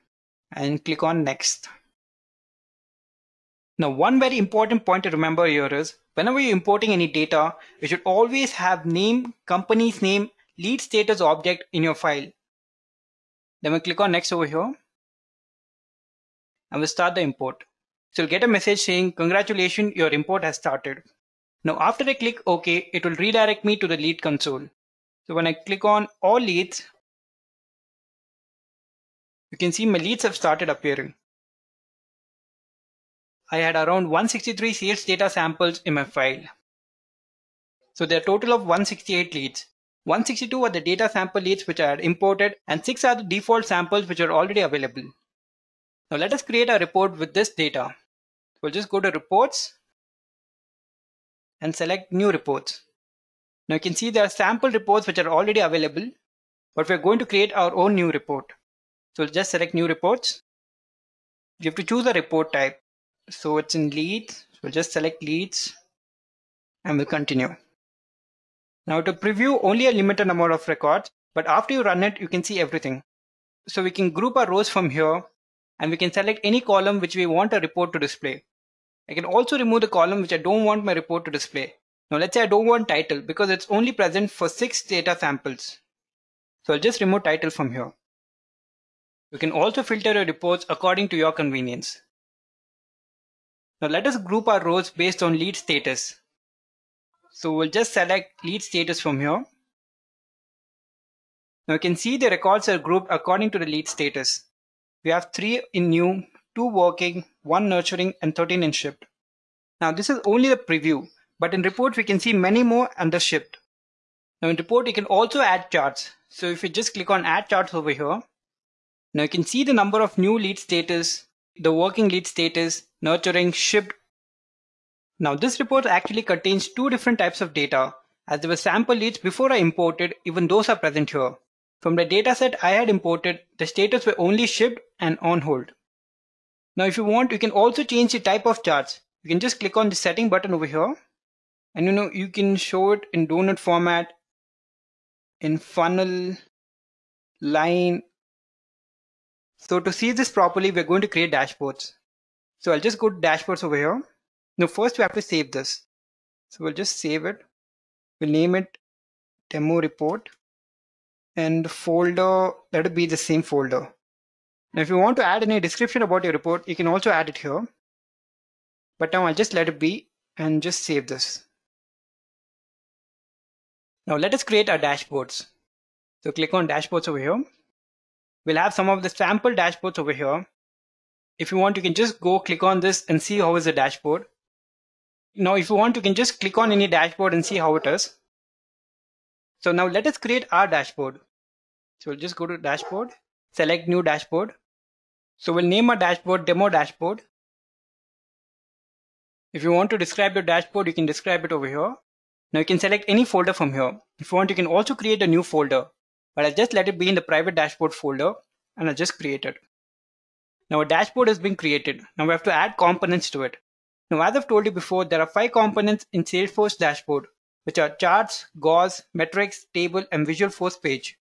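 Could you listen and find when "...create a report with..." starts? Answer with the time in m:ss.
0:46.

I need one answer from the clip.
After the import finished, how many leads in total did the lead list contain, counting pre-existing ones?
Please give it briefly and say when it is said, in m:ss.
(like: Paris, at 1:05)
168, at 0:38.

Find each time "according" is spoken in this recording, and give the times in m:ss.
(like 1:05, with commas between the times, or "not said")
1:30, 1:43.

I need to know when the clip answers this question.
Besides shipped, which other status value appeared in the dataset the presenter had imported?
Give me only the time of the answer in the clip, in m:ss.
2:15.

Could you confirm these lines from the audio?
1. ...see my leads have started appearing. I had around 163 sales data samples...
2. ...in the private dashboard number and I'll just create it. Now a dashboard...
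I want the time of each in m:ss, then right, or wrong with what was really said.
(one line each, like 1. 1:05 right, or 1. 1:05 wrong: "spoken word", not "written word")
1. 0:29 right
2. 3:27 wrong: "folder", not "number".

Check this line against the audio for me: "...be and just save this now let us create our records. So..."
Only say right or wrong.
wrong.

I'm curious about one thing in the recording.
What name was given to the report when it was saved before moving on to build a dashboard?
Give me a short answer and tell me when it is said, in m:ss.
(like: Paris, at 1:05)
demo report, at 2:39.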